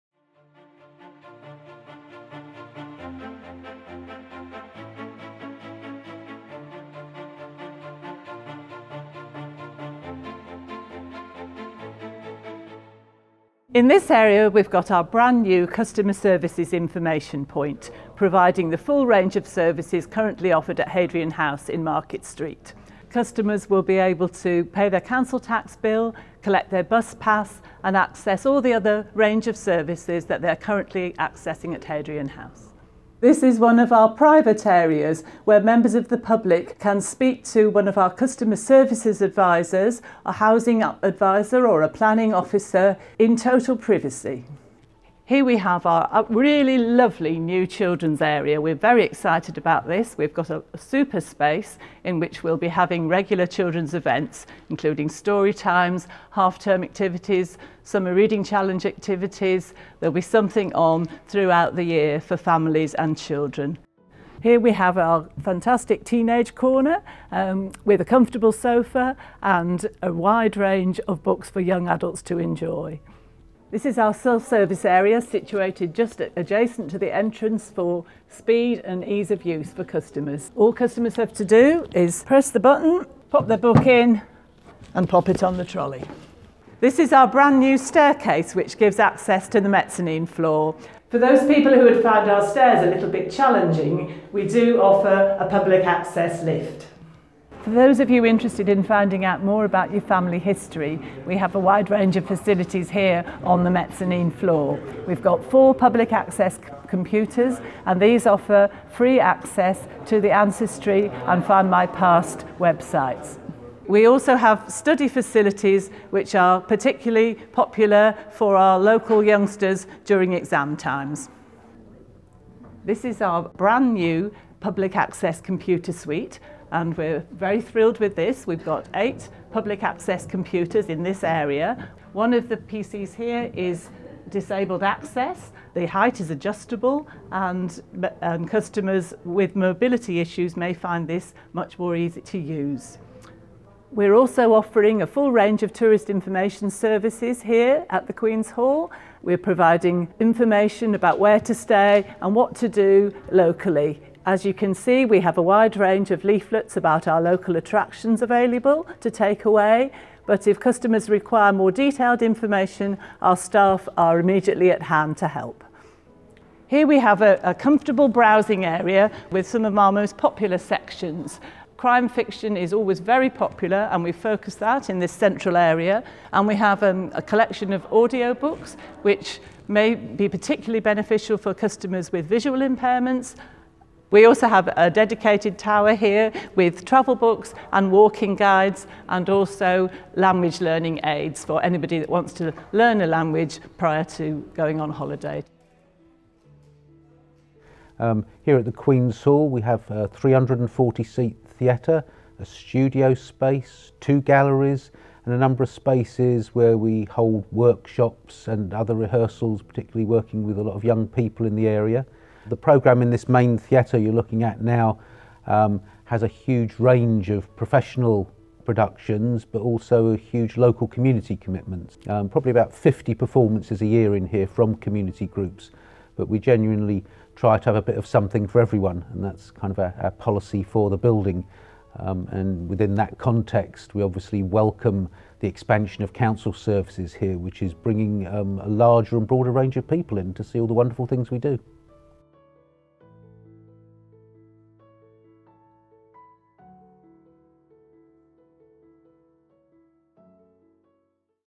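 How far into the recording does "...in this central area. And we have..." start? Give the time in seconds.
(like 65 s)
174 s.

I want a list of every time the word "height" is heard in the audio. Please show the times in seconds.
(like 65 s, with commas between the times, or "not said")
135 s.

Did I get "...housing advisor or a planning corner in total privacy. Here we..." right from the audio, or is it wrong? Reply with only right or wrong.
wrong.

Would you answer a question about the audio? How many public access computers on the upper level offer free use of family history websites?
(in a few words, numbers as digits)
4.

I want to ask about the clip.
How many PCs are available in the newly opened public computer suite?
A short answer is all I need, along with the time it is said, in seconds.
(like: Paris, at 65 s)
8, at 128 s.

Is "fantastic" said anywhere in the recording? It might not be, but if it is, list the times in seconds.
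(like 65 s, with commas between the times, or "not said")
65 s.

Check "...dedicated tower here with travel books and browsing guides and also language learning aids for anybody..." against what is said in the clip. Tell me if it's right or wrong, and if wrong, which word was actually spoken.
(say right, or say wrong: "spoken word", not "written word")
wrong: "walking", not "browsing".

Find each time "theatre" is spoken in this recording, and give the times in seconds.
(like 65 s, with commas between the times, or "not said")
201 s, 213 s.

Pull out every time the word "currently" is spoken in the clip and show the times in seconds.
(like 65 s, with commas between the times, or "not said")
20 s, 30 s.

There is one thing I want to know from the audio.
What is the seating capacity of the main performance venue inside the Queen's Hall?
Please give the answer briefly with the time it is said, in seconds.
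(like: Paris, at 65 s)
340, at 200 s.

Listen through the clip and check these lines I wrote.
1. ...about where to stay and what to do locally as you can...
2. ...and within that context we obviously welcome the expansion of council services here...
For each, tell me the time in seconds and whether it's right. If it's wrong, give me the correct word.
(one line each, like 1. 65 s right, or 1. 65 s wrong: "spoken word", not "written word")
1. 150 s right
2. 232 s right.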